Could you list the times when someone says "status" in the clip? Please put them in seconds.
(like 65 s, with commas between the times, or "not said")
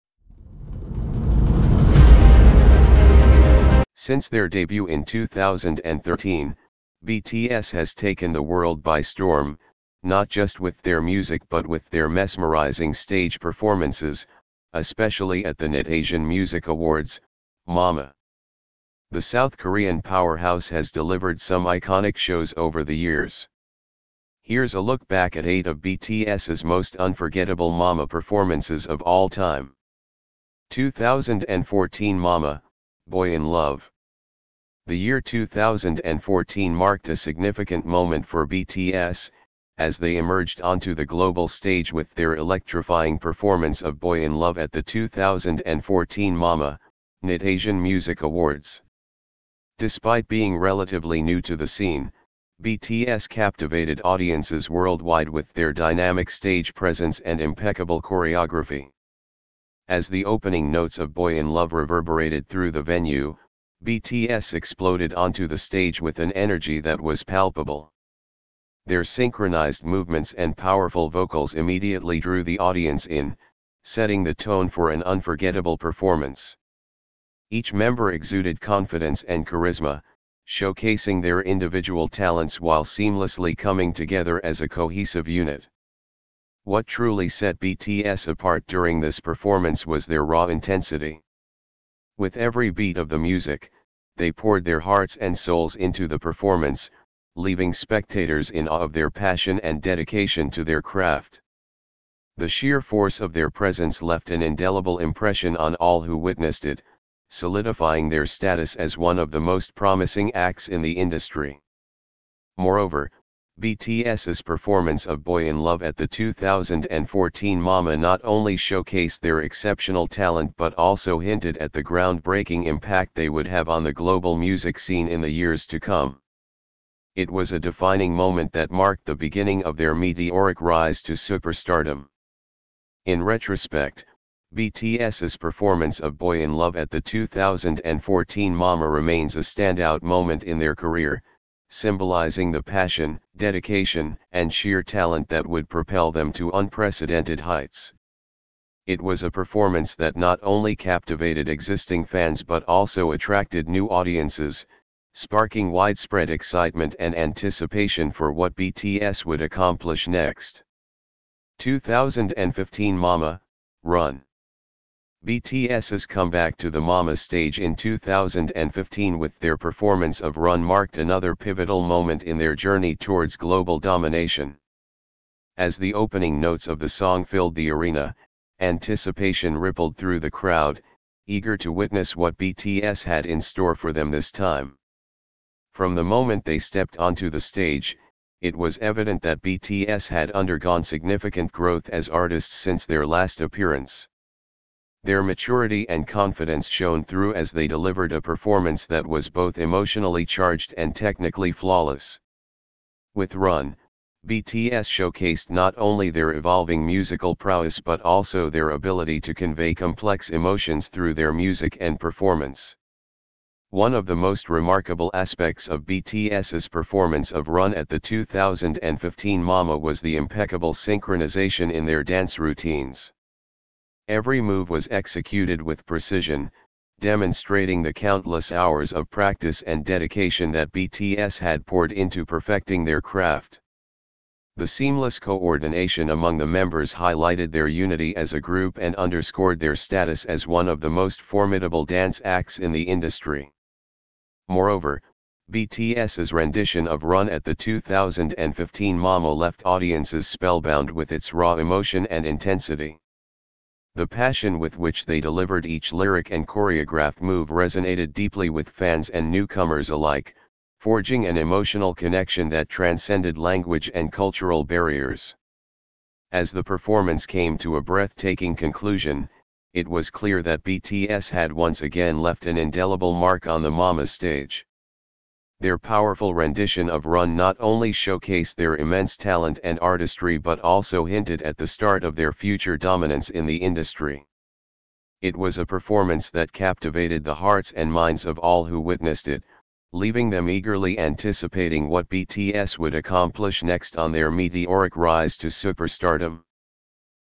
108 s, 239 s.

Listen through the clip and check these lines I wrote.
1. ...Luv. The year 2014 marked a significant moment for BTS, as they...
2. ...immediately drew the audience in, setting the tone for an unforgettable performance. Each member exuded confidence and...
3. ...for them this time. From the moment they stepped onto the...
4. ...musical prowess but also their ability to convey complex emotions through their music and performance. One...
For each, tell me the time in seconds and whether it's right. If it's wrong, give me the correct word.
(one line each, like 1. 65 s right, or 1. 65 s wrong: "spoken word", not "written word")
1. 33 s right
2. 71 s right
3. 183 s right
4. 206 s right.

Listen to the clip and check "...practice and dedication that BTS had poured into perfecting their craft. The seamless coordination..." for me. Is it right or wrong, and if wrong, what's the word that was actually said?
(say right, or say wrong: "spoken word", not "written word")
right.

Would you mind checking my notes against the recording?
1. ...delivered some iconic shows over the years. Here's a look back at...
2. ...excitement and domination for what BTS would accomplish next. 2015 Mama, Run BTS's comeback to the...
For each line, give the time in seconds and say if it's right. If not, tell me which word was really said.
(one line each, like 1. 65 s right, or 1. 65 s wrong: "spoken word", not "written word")
1. 20 s right
2. 156 s wrong: "anticipation", not "domination".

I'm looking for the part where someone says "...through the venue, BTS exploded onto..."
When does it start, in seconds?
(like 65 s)
62 s.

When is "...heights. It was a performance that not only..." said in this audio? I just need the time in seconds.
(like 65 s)
147 s.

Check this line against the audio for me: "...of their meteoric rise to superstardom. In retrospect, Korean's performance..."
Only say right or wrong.
wrong.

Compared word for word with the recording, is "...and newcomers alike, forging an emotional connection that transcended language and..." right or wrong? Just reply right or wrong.
right.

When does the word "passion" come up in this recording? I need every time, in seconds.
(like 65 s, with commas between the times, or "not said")
99 s, 142 s, 254 s.